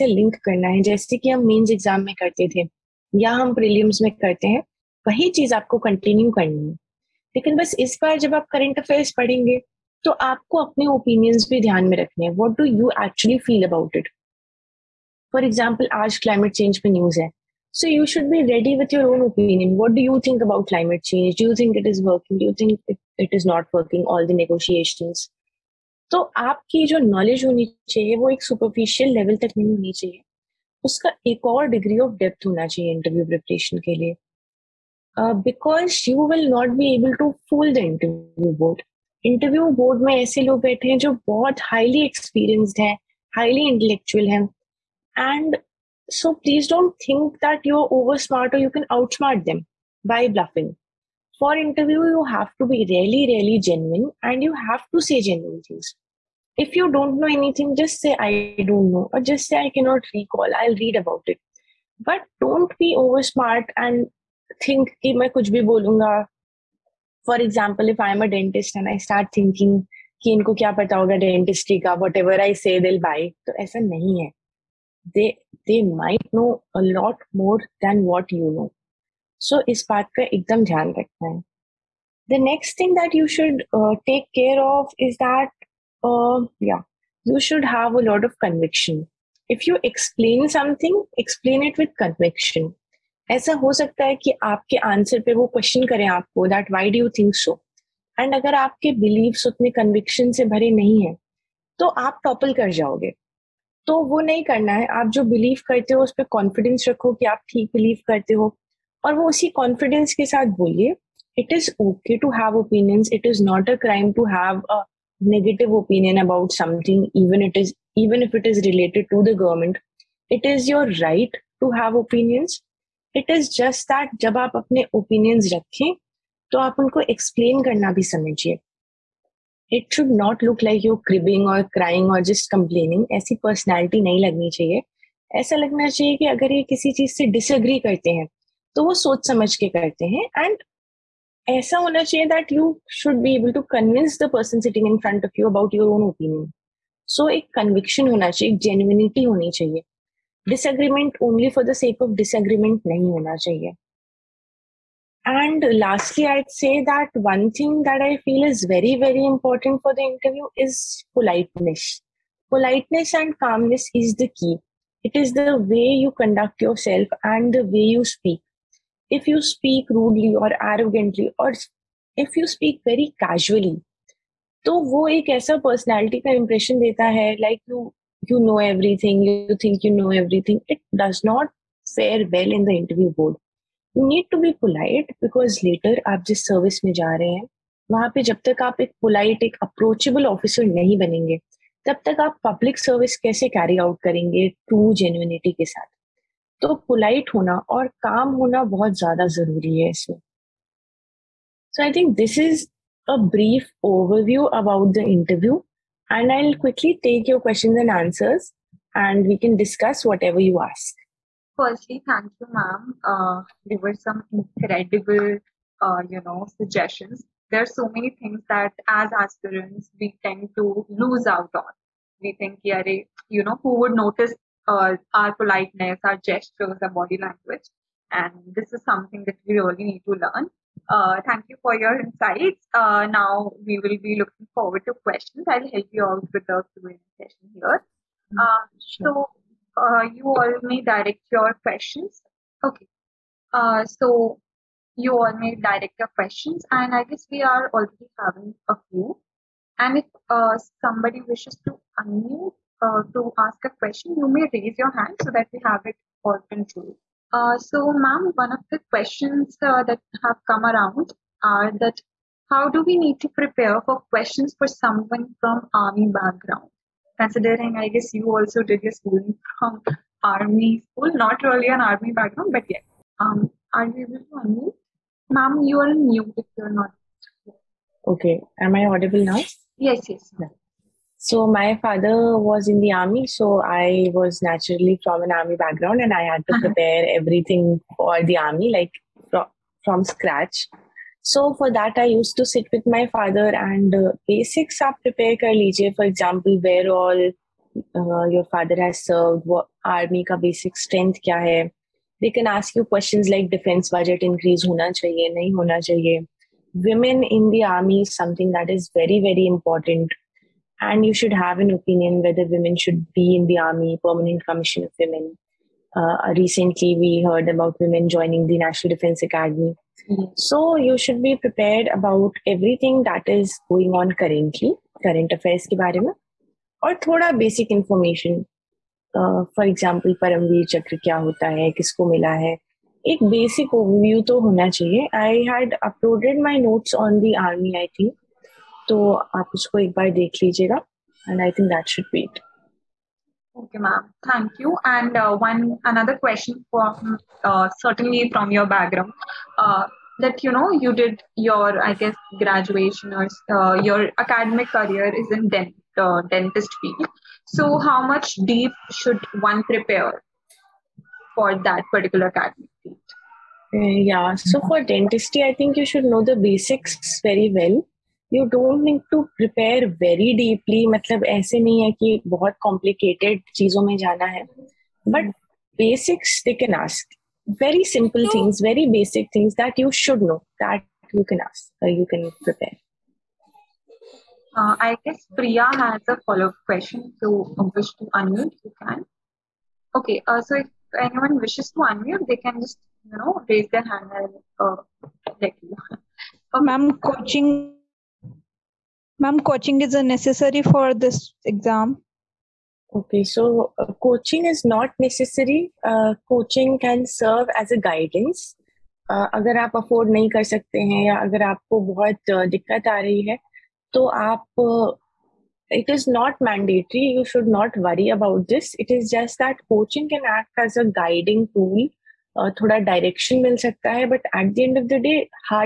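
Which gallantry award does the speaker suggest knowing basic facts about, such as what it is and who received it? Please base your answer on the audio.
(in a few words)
Paramveer Chakra.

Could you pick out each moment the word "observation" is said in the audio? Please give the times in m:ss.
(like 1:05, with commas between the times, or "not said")
not said.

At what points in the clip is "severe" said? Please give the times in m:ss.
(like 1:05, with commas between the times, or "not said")
not said.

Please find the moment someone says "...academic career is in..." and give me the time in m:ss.
5:54.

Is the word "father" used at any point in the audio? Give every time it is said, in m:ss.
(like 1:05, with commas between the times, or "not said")
4:41, 4:53, 4:58.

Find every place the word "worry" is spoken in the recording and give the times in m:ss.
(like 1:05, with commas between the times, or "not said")
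not said.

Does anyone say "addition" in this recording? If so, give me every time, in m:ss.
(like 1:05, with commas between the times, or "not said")
not said.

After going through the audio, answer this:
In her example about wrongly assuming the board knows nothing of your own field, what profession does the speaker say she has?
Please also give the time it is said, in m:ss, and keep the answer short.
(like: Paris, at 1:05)
Dentist, at 1:08.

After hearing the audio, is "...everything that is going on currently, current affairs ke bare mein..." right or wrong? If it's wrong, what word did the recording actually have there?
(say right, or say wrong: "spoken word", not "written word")
right.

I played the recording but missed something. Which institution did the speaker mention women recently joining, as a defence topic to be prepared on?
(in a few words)
National Defense Academy.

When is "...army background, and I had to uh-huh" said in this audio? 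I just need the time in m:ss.
4:45.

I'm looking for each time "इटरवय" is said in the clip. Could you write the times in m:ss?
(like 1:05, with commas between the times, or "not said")
0:32, 2:39, 3:25.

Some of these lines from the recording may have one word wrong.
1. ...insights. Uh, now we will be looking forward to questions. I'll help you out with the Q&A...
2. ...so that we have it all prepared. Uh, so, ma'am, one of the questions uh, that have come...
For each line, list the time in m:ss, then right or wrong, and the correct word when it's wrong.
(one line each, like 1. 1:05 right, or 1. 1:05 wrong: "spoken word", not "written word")
1. 3:51 right
2. 4:15 wrong: "controlled", not "prepared".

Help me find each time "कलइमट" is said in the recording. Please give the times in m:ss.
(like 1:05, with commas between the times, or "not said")
0:16, 0:20.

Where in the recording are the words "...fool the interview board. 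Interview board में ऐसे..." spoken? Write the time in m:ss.
0:37.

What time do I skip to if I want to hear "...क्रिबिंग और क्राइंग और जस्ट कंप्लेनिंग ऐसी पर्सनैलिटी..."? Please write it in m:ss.
2:11.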